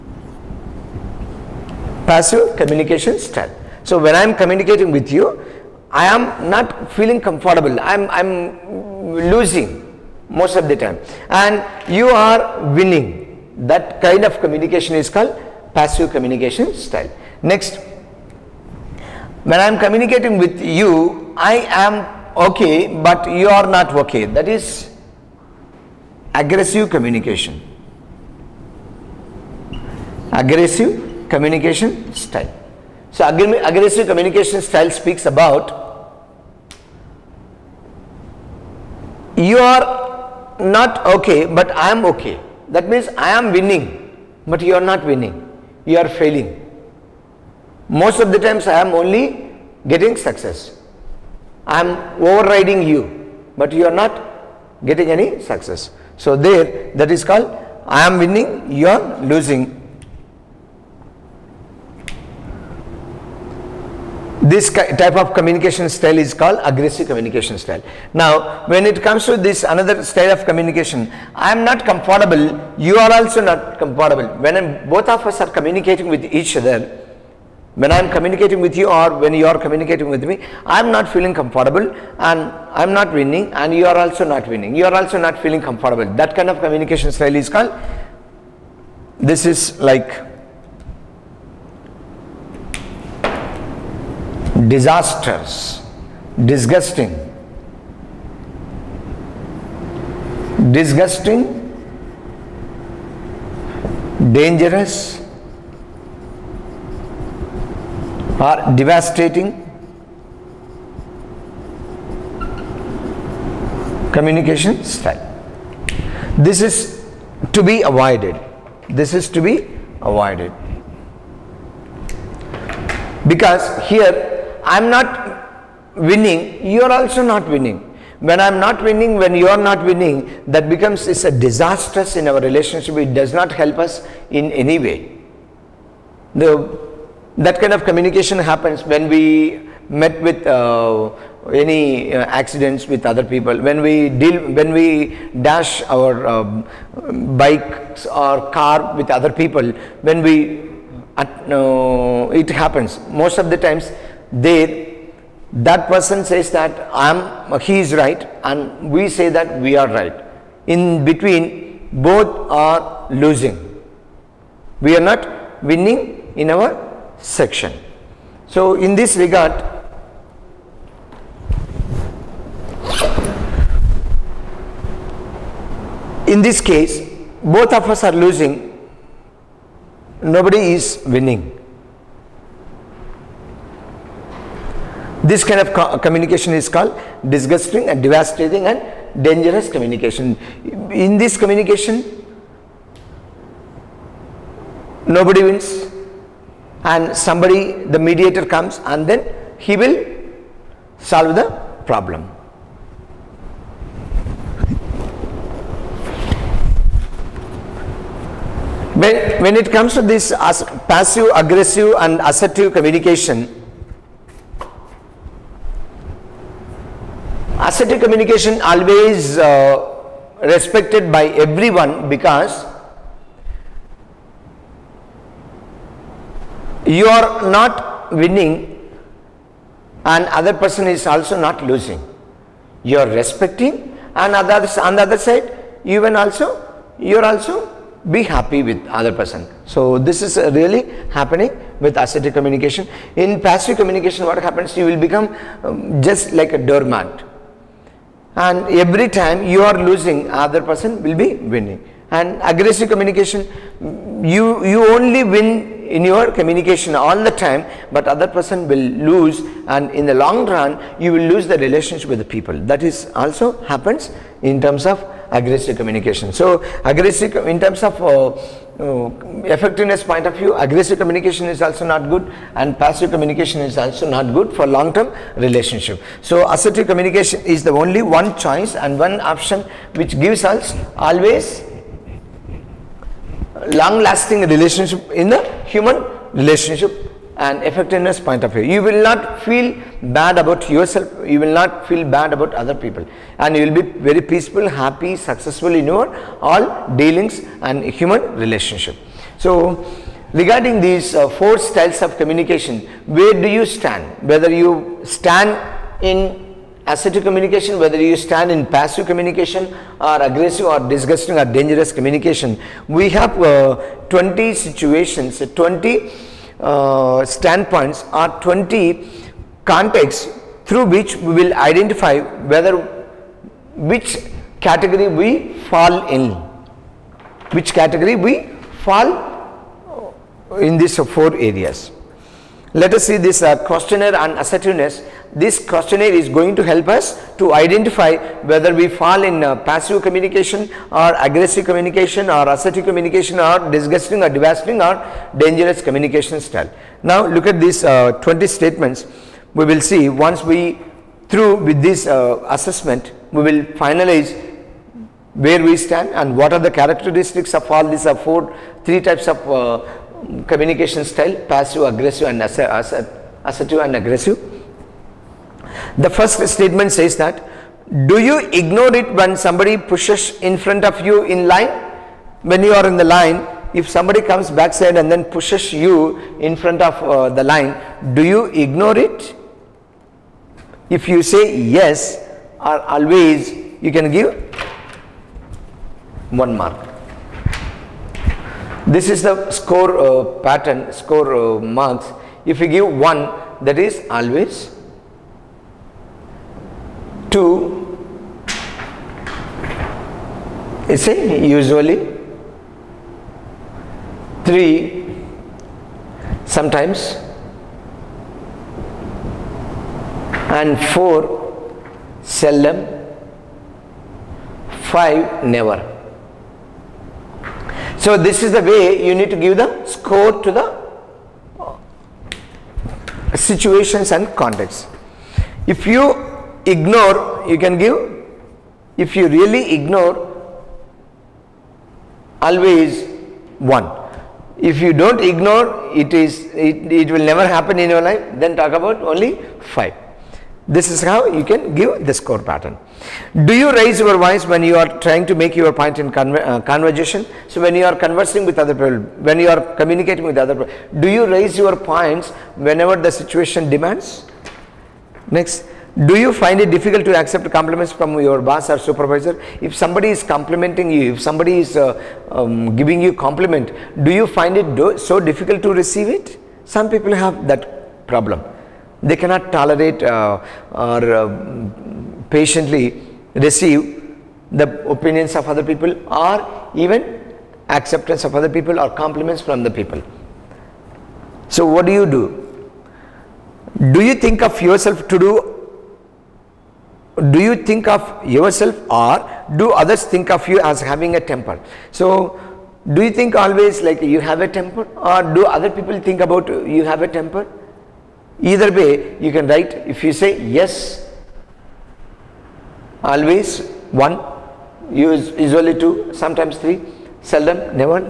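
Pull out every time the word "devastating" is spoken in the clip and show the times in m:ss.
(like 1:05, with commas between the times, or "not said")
1:48, 3:08, 5:44.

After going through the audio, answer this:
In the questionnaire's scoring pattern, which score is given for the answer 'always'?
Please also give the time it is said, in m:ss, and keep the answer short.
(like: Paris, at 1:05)
1, at 6:32.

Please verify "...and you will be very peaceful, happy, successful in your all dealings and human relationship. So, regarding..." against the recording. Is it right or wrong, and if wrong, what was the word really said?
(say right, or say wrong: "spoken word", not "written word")
right.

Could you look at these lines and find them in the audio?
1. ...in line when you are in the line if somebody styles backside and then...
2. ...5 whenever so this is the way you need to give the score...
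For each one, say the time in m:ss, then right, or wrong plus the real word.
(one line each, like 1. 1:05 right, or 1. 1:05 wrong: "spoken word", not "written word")
1. 6:11 wrong: "comes", not "styles"
2. 6:54 wrong: "never", not "whenever".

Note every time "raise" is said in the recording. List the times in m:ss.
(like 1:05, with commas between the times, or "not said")
7:23, 7:31.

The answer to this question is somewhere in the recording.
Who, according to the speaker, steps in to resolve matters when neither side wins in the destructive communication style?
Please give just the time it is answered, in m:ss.
3:17.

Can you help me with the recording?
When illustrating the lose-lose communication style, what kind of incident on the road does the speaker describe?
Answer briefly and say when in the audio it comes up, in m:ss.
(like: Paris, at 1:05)
accidents, at 2:22.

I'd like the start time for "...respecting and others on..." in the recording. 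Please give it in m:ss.
3:53.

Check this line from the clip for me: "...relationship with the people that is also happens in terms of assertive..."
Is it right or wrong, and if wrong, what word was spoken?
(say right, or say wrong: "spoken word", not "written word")
wrong: "aggressive", not "assertive".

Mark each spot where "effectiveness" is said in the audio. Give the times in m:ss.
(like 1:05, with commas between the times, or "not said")
4:28, 4:47.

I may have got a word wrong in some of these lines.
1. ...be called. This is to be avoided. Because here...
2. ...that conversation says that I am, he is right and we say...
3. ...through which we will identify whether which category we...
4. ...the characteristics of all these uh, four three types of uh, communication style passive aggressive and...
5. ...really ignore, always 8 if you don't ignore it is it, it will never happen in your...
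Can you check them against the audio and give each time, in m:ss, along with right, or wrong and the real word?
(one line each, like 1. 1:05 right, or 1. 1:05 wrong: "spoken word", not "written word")
1. 1:57 wrong: "avoided", not "called"
2. 2:35 wrong: "person", not "conversation"
3. 5:20 right
4. 5:56 right
5. 7:09 wrong: "1", not "8".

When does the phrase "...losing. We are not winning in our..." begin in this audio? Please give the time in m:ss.
2:43.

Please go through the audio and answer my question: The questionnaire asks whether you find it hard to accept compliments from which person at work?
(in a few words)
boss or supervisor.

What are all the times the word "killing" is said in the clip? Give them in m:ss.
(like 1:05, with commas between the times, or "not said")
not said.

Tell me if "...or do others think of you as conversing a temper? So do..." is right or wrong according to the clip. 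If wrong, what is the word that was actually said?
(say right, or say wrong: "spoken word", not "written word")
wrong: "having", not "conversing".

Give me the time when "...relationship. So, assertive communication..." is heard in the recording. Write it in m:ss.
4:35.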